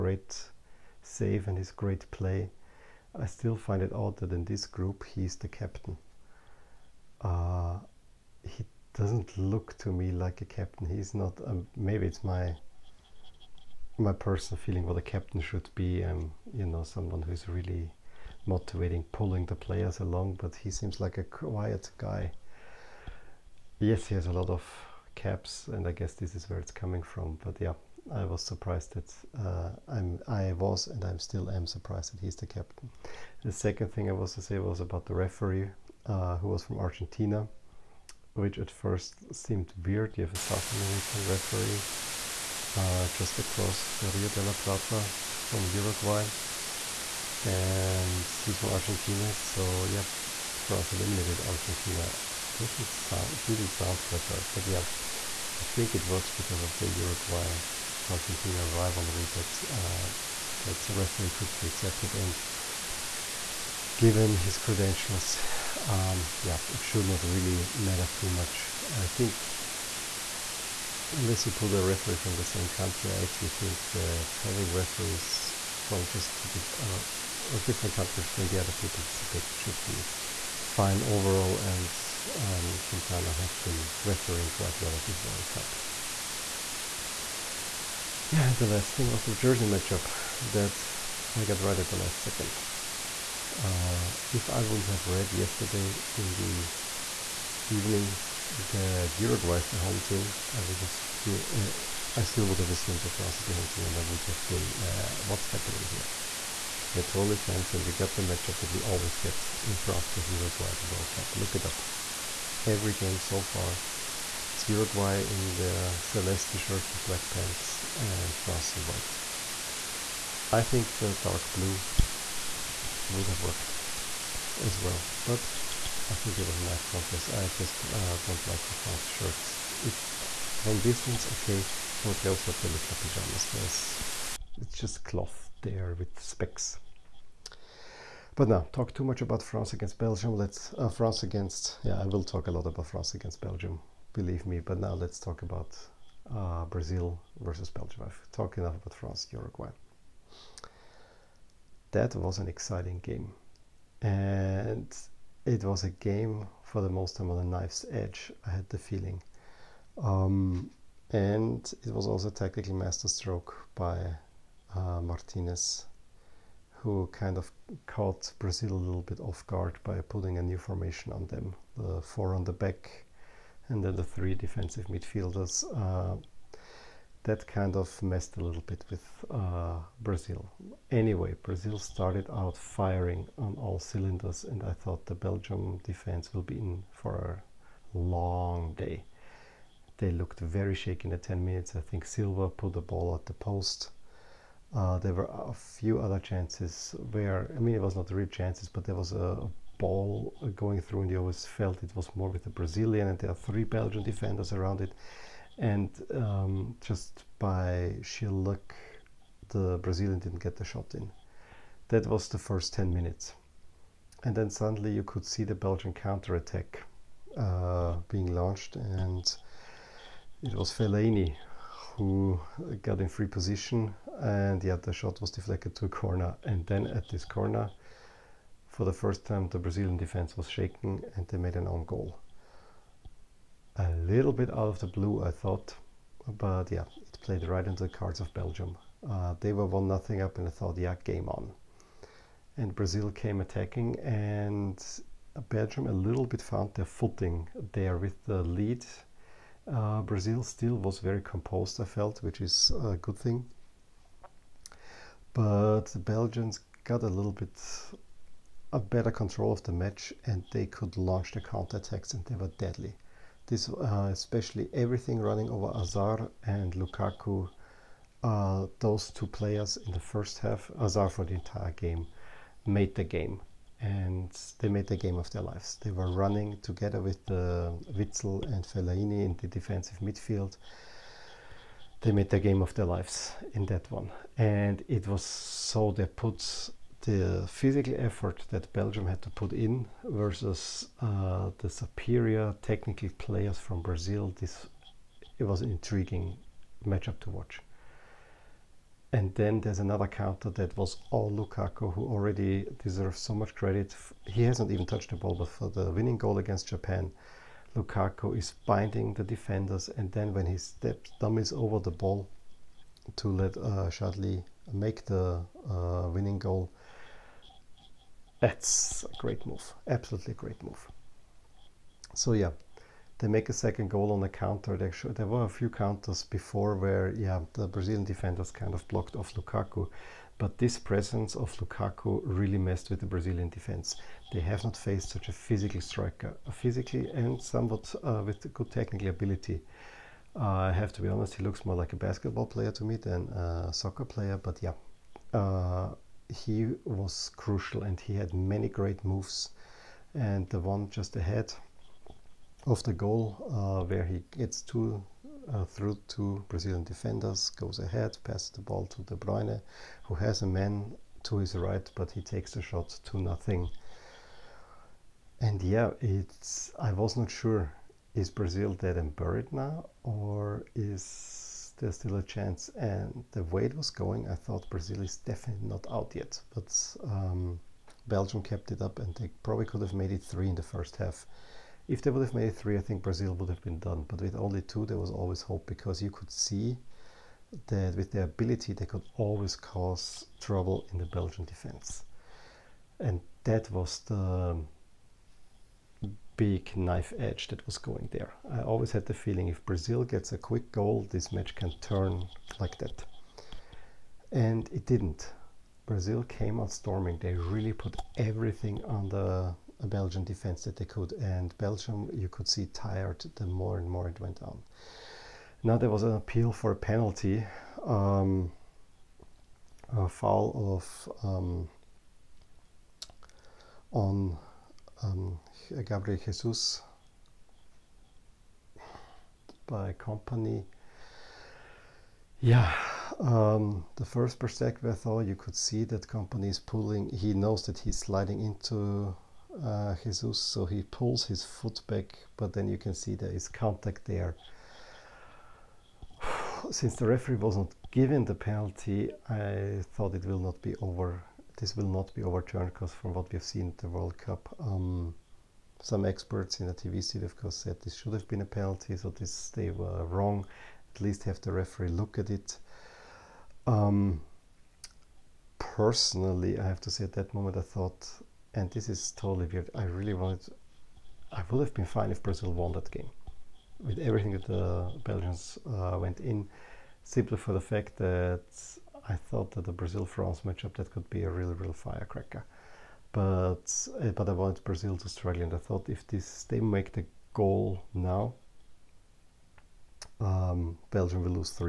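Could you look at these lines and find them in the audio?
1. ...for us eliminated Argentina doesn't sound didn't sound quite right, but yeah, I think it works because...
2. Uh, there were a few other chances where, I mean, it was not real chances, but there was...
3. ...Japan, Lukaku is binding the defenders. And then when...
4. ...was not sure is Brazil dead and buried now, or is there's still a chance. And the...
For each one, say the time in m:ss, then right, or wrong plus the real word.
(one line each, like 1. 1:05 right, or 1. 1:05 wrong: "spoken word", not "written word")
1. 0:50 right
2. 3:14 right
3. 5:06 right
4. 6:06 right.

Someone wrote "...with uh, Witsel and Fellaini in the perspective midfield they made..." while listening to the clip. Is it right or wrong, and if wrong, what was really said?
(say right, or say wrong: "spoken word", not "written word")
wrong: "defensive", not "perspective".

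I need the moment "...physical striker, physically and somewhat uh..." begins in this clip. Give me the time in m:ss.
5:35.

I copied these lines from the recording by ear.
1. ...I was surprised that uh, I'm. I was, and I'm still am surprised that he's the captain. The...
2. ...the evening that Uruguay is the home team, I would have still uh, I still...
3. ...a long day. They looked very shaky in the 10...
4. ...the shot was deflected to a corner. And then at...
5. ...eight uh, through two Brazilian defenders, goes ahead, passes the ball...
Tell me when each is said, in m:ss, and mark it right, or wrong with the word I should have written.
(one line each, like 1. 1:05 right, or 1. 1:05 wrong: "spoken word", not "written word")
1. 0:28 right
2. 1:36 right
3. 3:07 right
4. 3:44 right
5. 5:54 wrong: "two", not "eight".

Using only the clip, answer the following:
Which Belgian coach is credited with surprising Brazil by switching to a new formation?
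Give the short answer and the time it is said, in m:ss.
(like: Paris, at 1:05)
Martinez, at 2:45.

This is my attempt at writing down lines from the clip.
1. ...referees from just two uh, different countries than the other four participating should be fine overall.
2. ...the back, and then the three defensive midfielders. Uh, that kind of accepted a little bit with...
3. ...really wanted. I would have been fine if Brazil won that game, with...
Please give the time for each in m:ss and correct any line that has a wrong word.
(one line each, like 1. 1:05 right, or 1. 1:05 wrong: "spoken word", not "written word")
1. 1:14 wrong: "two", not "four"
2. 2:52 wrong: "messed", not "accepted"
3. 7:49 right.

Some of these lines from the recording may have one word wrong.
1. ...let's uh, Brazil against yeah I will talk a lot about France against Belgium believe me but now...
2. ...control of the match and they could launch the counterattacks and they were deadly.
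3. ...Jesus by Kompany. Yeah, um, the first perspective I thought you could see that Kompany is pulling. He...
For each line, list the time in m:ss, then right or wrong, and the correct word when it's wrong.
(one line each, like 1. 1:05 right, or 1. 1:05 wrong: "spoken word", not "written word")
1. 2:20 wrong: "France", not "Brazil"
2. 4:19 right
3. 7:06 right.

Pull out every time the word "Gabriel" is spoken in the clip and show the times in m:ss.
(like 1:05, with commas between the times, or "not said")
7:05.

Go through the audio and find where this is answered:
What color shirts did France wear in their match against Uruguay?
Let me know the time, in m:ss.
1:58.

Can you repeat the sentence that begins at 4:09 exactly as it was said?
Uh, Brazil still was very composed, I felt, which is a good thing.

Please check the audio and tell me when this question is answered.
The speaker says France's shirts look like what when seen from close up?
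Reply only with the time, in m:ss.
2:13.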